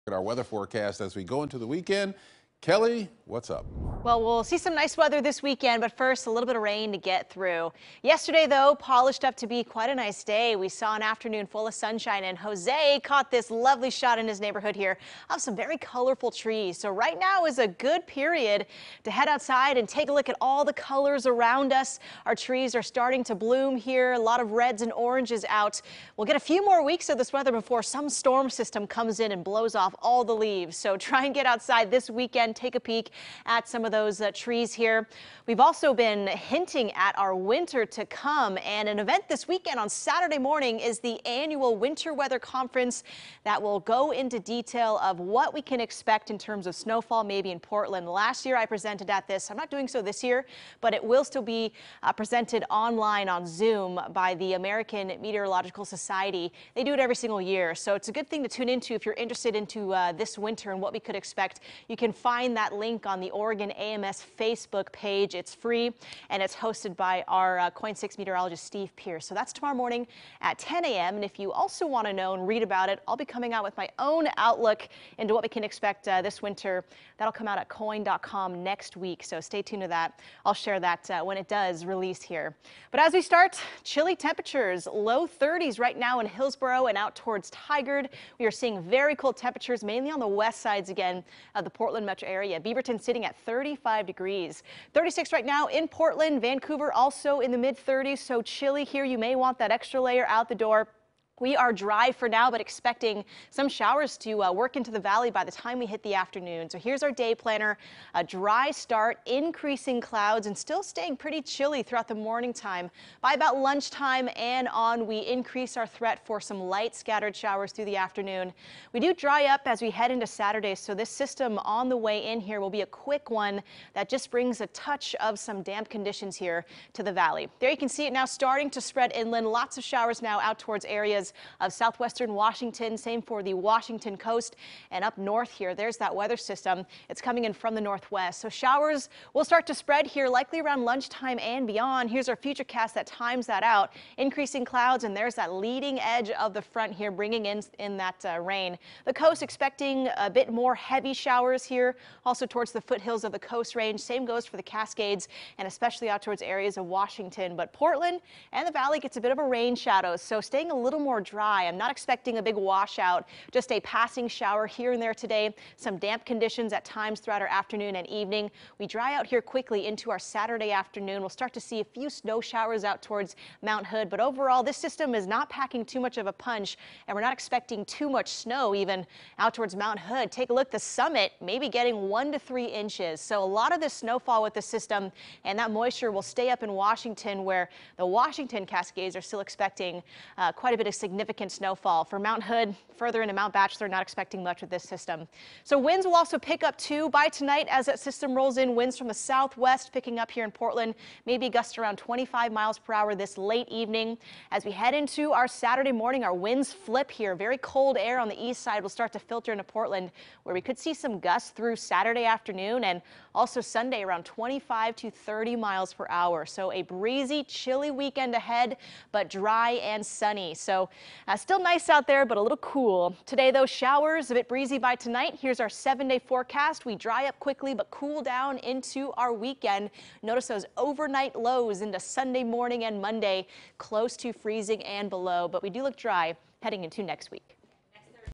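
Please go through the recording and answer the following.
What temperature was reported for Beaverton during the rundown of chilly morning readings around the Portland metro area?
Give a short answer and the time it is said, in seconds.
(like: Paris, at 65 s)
35 degrees, at 93 s.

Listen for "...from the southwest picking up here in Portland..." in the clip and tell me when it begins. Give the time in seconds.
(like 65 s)
198 s.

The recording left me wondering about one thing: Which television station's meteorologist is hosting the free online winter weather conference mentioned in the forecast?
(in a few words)
KOIN 6.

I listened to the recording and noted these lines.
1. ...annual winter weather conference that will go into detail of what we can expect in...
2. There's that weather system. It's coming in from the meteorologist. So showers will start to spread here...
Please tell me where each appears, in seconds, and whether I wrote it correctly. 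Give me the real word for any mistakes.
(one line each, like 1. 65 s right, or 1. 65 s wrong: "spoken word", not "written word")
1. 41 s right
2. 135 s wrong: "northwest", not "meteorologist".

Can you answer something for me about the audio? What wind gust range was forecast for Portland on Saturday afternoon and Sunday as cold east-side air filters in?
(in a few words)
25 to 30 mph.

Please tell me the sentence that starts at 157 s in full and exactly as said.
But Portland and the valley gets a bit of a rain shadow.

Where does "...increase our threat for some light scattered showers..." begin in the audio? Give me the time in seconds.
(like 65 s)
115 s.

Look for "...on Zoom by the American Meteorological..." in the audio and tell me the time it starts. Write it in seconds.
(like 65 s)
53 s.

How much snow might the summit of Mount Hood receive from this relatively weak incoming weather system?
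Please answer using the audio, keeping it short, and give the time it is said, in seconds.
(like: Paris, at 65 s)
1 to 3 inches, at 182 s.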